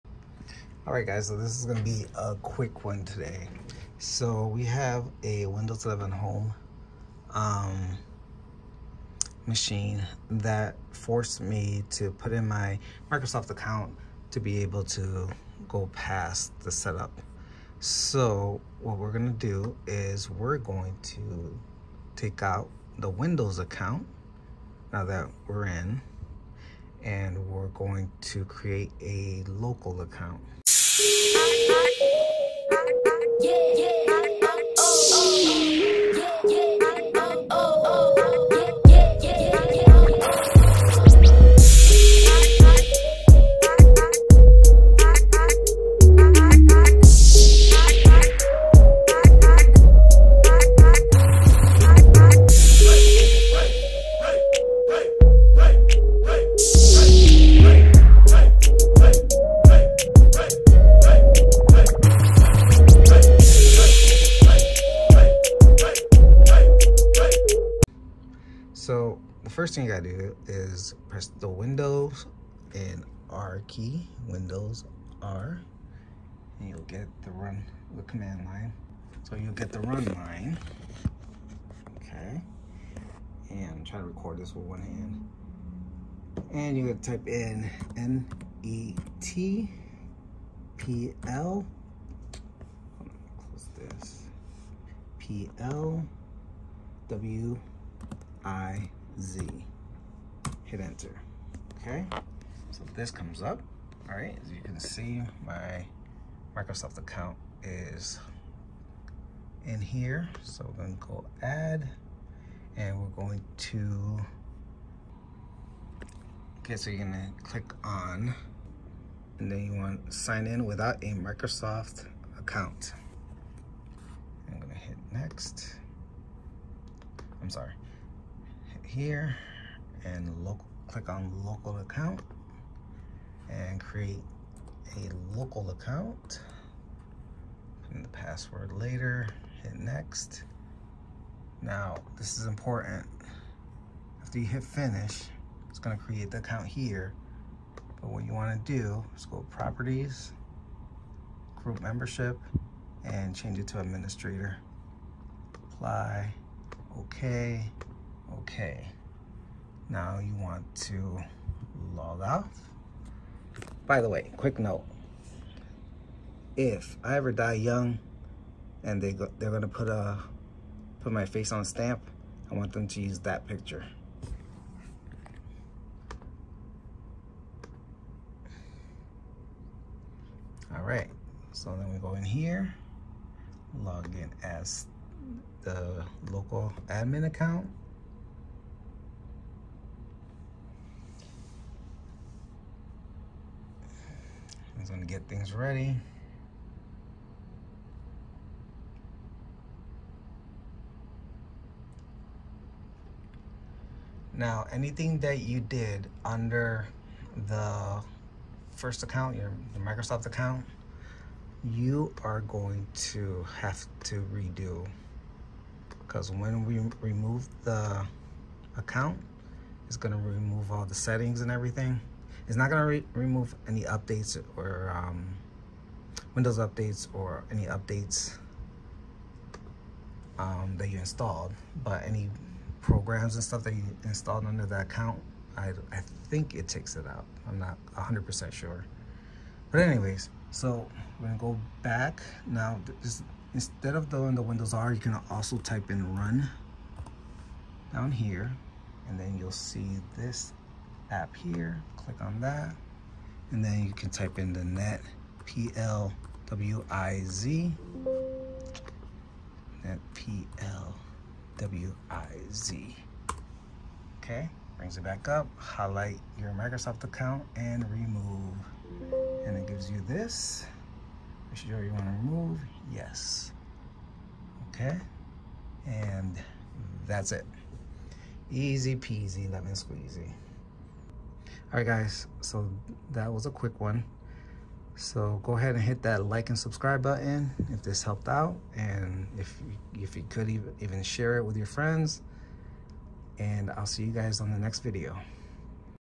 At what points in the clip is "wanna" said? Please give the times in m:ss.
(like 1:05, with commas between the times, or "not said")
2:28.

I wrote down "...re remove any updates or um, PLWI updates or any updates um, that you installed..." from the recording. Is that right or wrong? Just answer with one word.
wrong.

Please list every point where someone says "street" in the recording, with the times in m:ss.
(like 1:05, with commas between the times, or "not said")
not said.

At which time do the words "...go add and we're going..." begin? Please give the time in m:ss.
1:50.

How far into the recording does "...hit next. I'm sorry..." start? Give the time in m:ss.
2:04.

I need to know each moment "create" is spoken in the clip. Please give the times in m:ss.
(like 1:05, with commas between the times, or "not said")
0:28, 2:13, 2:25.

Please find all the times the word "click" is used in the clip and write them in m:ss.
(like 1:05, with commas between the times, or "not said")
1:57, 2:10, 4:11.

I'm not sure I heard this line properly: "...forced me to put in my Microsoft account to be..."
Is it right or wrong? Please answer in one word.
right.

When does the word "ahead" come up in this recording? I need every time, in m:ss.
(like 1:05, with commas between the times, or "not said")
4:45.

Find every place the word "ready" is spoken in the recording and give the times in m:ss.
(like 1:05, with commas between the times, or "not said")
3:15.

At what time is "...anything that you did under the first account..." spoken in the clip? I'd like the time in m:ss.
3:24.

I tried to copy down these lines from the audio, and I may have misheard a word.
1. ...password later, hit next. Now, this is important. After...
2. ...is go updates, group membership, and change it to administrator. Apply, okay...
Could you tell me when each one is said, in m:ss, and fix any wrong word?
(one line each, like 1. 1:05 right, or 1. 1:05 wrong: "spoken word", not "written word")
1. 2:18 right
2. 2:29 wrong: "properties", not "updates".